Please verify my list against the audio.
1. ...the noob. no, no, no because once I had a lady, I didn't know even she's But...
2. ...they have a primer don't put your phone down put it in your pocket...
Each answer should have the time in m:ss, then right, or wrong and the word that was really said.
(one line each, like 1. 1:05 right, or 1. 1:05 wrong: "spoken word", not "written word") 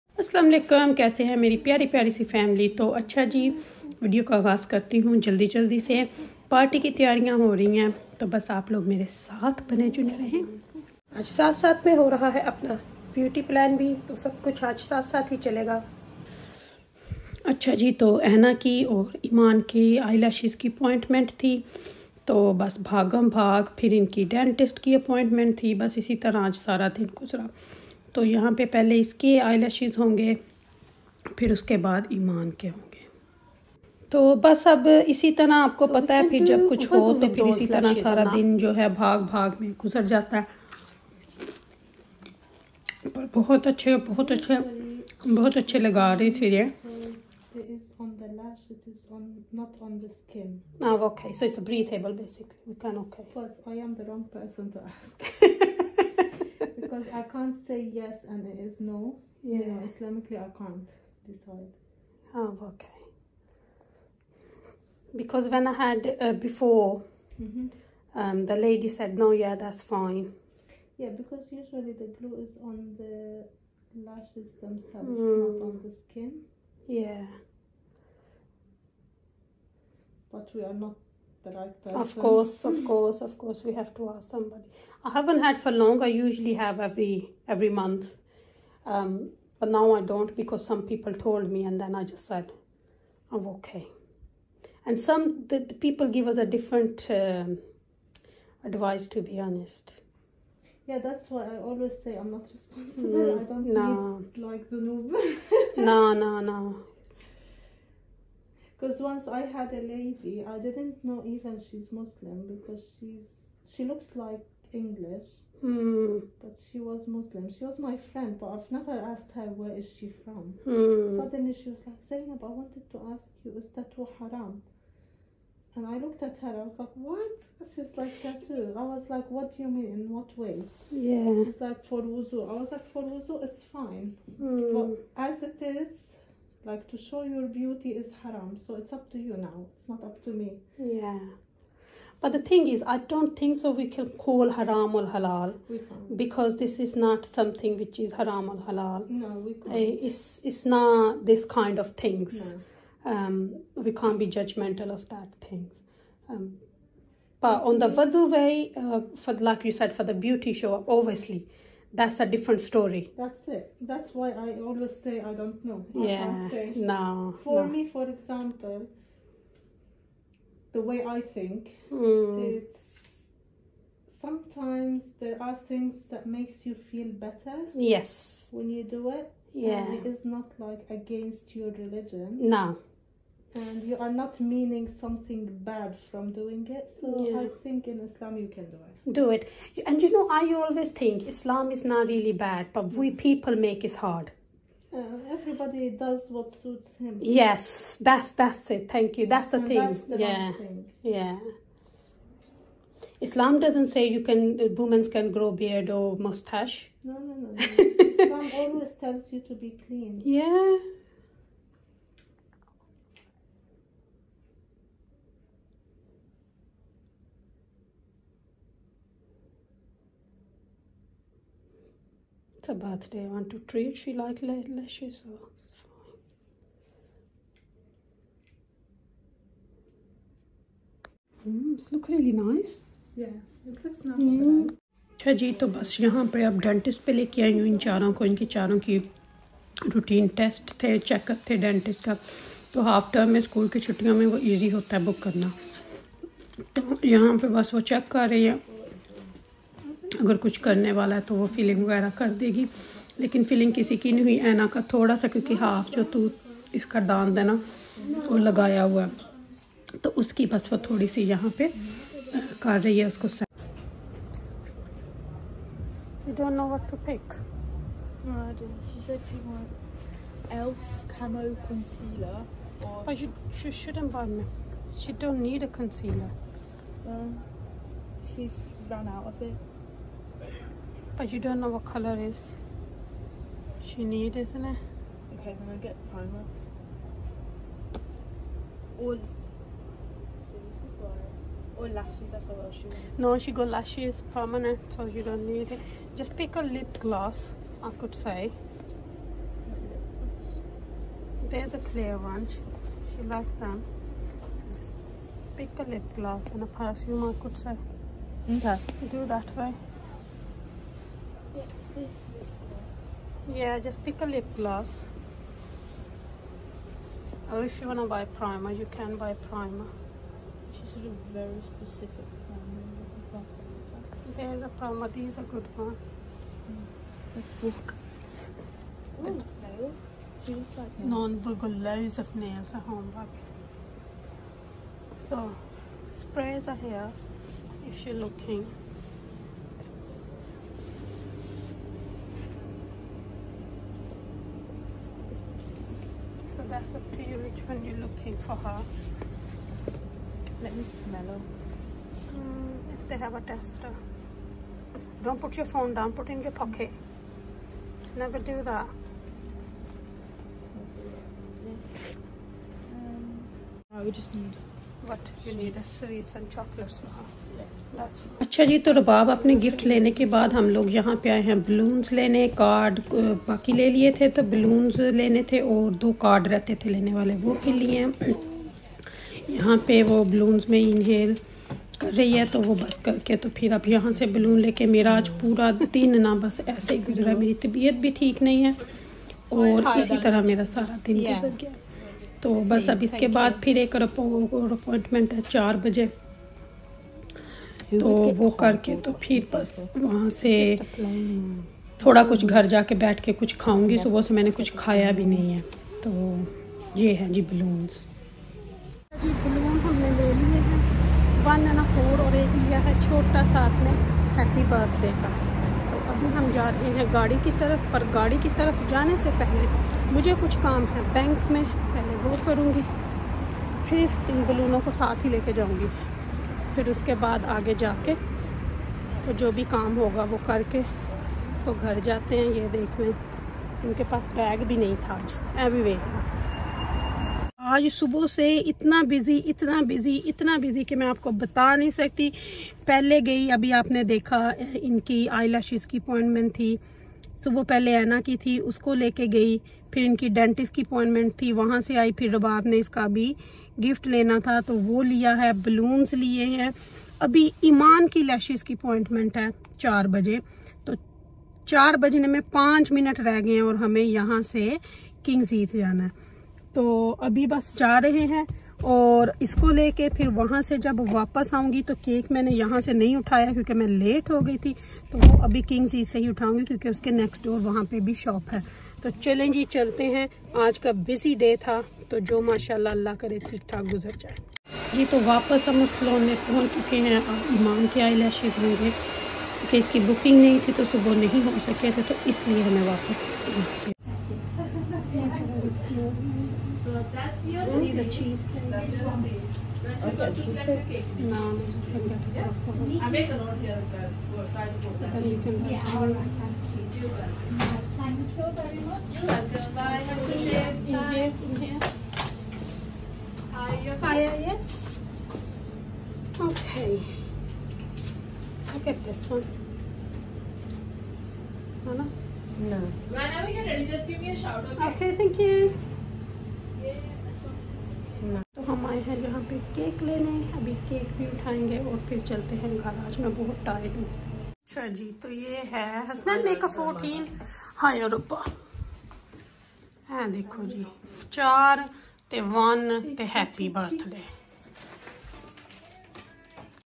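1. 1:44 wrong: "Muslim", not "But"
2. 5:53 wrong: "tester", not "primer".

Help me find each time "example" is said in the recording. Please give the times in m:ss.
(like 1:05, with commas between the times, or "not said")
2:48.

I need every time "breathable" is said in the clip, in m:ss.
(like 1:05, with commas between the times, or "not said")
0:51.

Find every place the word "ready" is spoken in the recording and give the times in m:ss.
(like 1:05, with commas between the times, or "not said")
8:43.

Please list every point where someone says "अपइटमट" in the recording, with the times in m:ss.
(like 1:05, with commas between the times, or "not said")
0:20, 0:25, 6:33, 7:25, 7:30, 7:38.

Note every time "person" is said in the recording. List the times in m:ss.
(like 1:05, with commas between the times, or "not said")
0:54, 1:21.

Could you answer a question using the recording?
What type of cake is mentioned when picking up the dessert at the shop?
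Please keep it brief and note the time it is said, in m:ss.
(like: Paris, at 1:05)
Cheesecake, at 8:18.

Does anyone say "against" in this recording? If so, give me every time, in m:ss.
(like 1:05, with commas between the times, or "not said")
3:00.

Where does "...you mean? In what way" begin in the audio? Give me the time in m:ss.
2:09.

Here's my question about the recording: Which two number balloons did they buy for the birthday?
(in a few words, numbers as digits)
1 and 4.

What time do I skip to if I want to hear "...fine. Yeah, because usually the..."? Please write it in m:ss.
1:09.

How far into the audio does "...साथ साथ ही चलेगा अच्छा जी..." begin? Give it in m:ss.
0:14.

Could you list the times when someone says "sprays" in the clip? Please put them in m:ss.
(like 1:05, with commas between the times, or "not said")
5:36.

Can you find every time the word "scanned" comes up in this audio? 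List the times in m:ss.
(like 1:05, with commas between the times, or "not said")
not said.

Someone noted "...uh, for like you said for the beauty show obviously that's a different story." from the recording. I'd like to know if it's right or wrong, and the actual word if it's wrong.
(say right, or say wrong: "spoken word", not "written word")
right.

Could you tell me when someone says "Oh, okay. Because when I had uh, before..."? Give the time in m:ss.
1:02.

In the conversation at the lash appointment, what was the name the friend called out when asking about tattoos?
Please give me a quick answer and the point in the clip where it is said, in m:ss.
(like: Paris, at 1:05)
Zainab, at 2:02.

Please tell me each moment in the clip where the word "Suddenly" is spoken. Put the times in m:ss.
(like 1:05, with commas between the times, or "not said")
2:01.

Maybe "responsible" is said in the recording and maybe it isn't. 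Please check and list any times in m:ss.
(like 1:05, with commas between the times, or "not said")
1:42.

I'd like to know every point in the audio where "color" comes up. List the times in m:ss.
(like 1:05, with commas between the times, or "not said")
4:41.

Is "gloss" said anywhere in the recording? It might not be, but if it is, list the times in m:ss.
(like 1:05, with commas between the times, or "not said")
4:56, 5:06, 5:14.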